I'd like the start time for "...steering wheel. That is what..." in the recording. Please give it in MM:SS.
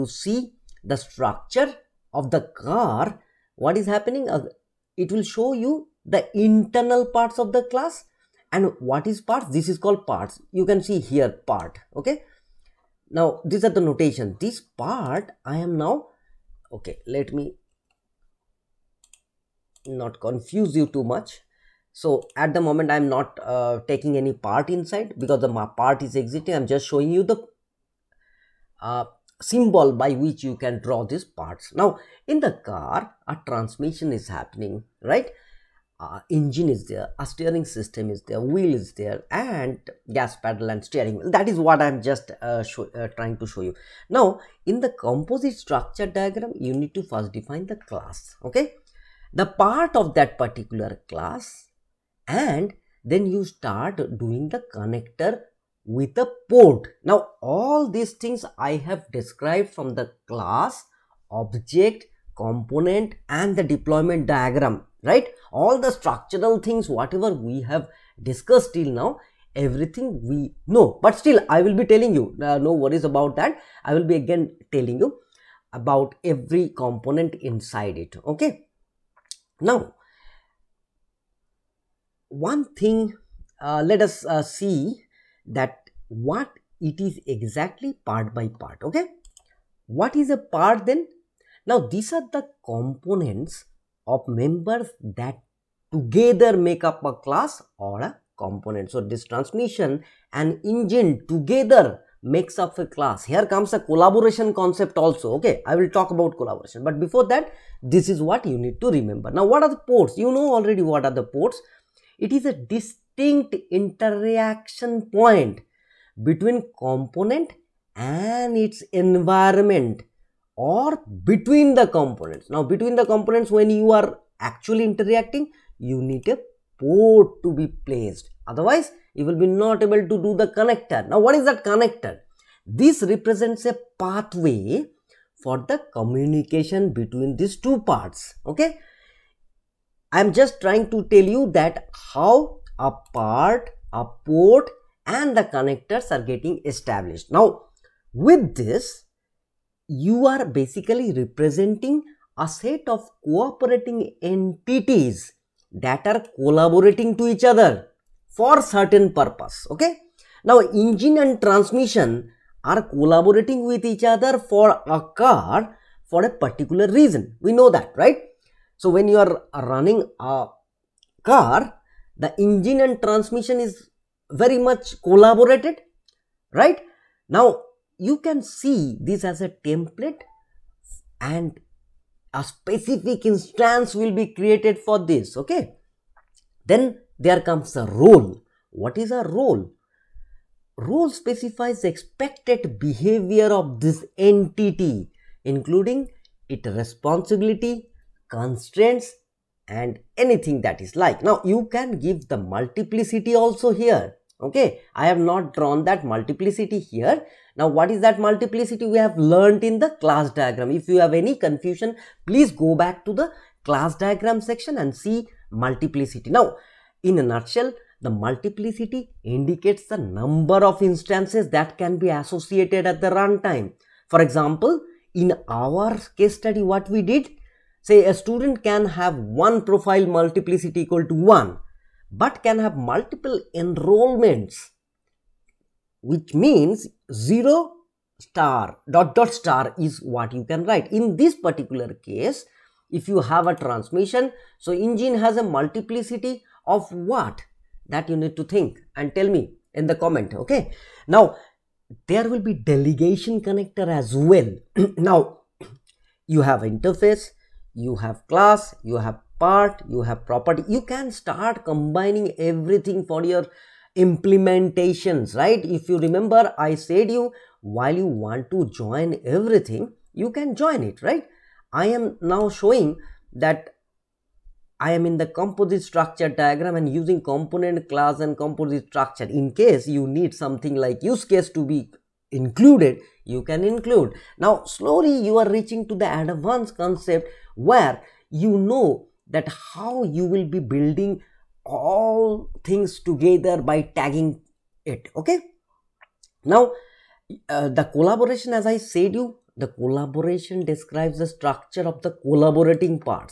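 00:40.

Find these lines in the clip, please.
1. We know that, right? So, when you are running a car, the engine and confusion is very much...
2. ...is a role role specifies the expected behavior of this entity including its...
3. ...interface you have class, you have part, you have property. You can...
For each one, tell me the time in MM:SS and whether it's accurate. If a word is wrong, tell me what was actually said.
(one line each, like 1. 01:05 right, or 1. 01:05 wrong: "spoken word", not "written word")
1. 02:47 wrong: "transmission", not "confusion"
2. 03:08 right
3. 04:16 right.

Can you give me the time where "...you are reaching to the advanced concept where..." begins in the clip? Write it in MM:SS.
04:45.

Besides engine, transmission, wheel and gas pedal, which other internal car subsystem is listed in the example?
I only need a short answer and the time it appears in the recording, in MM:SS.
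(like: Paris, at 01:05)
Steering system, at 00:37.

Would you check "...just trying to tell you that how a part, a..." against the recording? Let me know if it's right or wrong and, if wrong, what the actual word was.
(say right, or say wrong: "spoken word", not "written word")
right.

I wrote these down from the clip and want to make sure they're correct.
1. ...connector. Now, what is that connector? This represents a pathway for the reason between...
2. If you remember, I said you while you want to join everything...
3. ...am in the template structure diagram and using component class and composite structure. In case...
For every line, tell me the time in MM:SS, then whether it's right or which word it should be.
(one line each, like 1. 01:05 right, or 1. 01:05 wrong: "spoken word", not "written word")
1. 02:10 wrong: "communication", not "reason"
2. 04:25 right
3. 04:34 wrong: "composite", not "template".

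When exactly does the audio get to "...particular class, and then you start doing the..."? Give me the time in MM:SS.
00:50.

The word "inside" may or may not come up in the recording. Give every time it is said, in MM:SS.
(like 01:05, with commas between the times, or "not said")
00:24, 01:17.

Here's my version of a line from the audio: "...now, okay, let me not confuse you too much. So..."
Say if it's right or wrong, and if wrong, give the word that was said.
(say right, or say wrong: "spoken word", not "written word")
right.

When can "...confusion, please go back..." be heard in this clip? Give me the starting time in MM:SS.
03:31.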